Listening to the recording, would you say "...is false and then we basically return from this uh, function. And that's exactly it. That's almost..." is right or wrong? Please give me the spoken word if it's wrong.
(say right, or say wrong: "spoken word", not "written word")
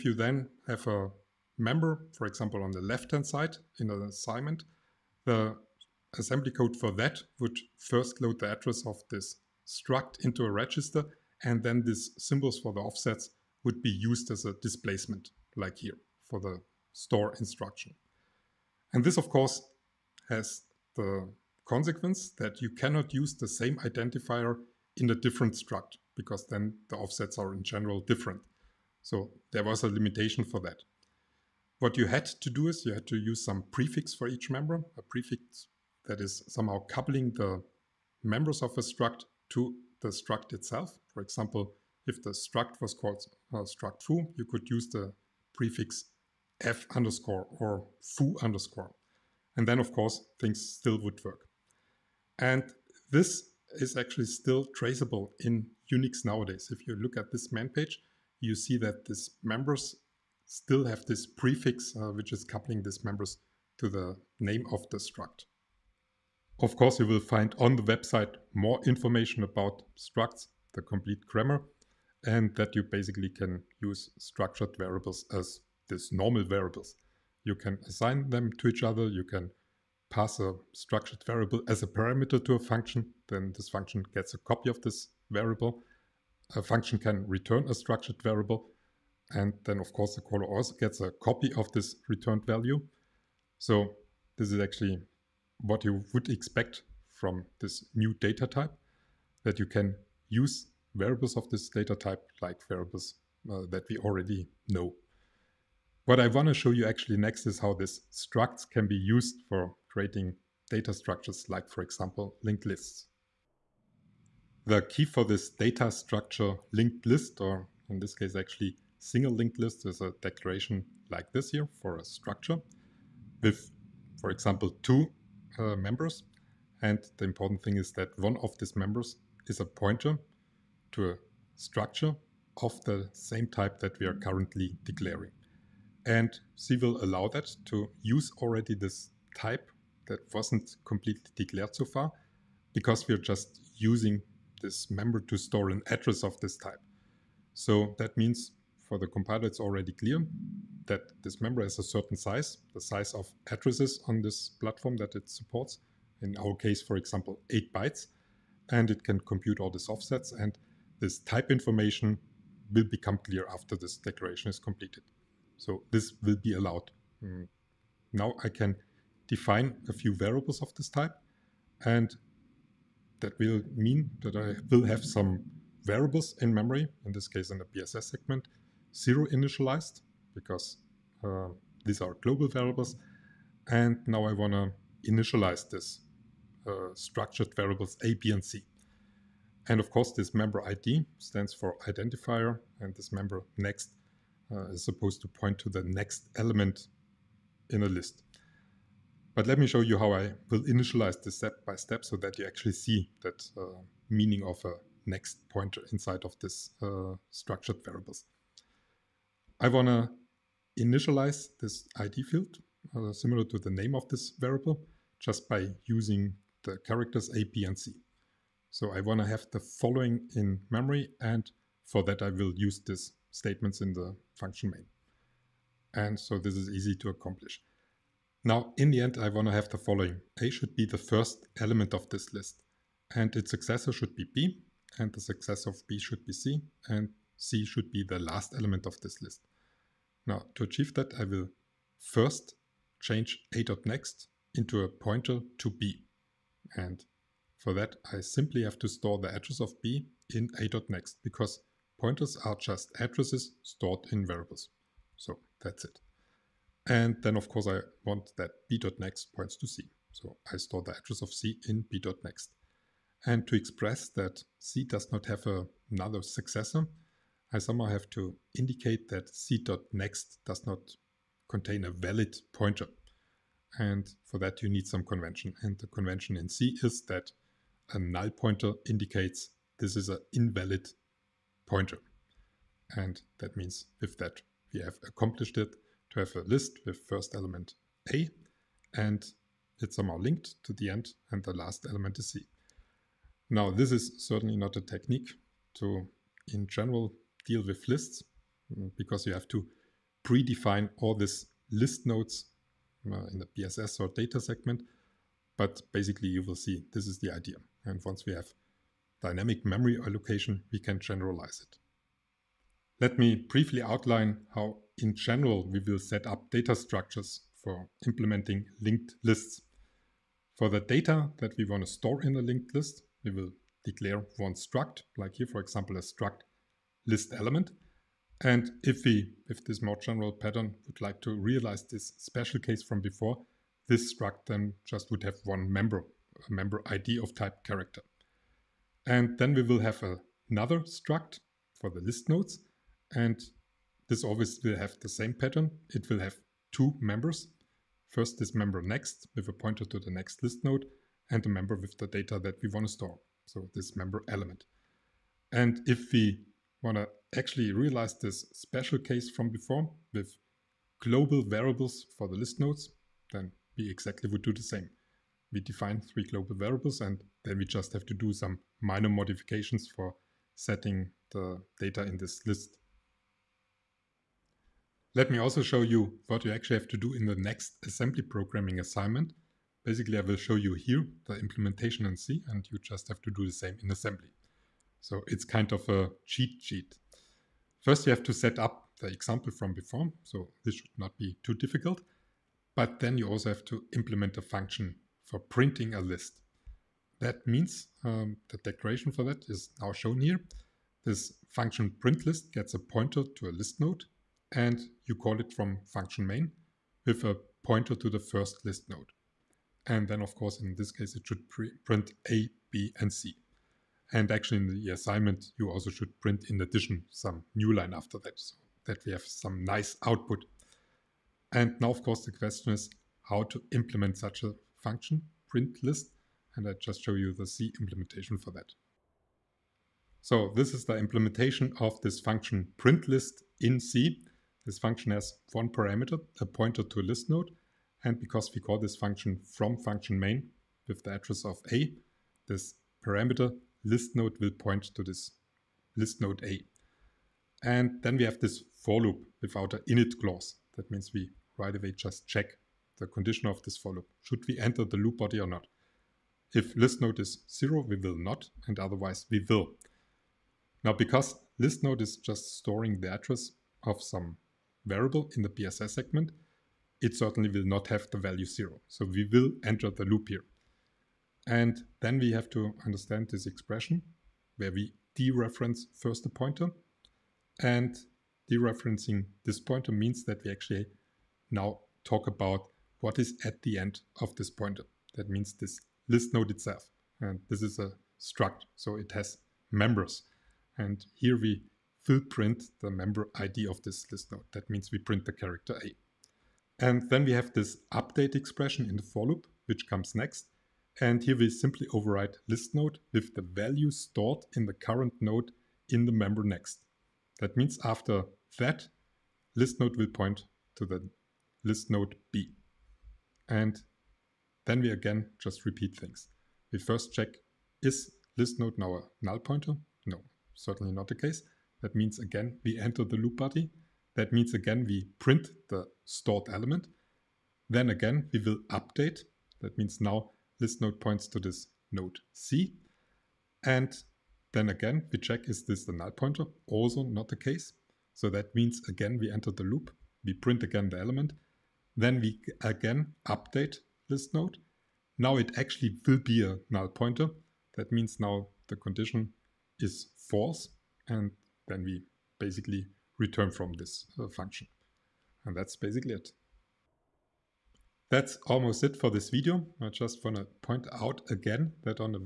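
wrong: "basically", not "exactly".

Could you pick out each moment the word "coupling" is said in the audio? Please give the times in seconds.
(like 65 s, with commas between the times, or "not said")
36 s, 62 s.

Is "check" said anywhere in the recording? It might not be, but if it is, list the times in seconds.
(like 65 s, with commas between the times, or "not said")
452 s, 517 s, 535 s.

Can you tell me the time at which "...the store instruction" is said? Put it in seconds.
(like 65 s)
16 s.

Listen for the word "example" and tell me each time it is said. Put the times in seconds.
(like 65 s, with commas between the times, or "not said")
2 s, 41 s, 111 s, 124 s, 156 s, 325 s, 389 s.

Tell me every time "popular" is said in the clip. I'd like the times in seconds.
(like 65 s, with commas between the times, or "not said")
not said.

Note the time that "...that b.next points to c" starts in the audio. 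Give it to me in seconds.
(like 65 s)
258 s.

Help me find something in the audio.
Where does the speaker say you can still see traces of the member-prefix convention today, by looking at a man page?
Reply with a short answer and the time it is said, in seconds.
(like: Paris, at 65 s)
Unix, at 55 s.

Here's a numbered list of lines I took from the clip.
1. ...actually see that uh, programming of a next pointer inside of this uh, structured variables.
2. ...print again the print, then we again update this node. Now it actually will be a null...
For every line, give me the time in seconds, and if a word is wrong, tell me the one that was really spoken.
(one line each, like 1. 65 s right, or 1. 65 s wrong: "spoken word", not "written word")
1. 202 s wrong: "meaning", not "programming"
2. 540 s wrong: "element", not "print".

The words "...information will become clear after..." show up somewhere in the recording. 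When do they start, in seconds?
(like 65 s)
161 s.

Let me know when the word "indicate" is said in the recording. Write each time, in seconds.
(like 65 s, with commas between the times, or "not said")
268 s, 278 s.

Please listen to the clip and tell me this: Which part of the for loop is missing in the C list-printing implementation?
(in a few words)
init clause.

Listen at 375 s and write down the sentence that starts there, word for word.
Let me also show you what you actually have to do in the next assembly programming assignment.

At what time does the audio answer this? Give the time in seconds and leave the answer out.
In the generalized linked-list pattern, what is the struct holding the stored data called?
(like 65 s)
326 s.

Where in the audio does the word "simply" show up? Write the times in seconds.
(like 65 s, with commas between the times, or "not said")
248 s, 501 s.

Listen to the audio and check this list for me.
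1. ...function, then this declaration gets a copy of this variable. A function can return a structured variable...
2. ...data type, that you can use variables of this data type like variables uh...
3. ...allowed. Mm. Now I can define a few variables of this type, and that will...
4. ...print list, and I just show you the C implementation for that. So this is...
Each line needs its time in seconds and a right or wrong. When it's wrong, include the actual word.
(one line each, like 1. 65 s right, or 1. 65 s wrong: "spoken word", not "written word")
1. 82 s wrong: "function", not "declaration"
2. 98 s right
3. 166 s right
4. 425 s right.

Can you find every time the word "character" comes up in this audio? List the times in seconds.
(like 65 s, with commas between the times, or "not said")
216 s, 337 s, 495 s.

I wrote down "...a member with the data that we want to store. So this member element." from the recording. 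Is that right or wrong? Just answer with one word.
right.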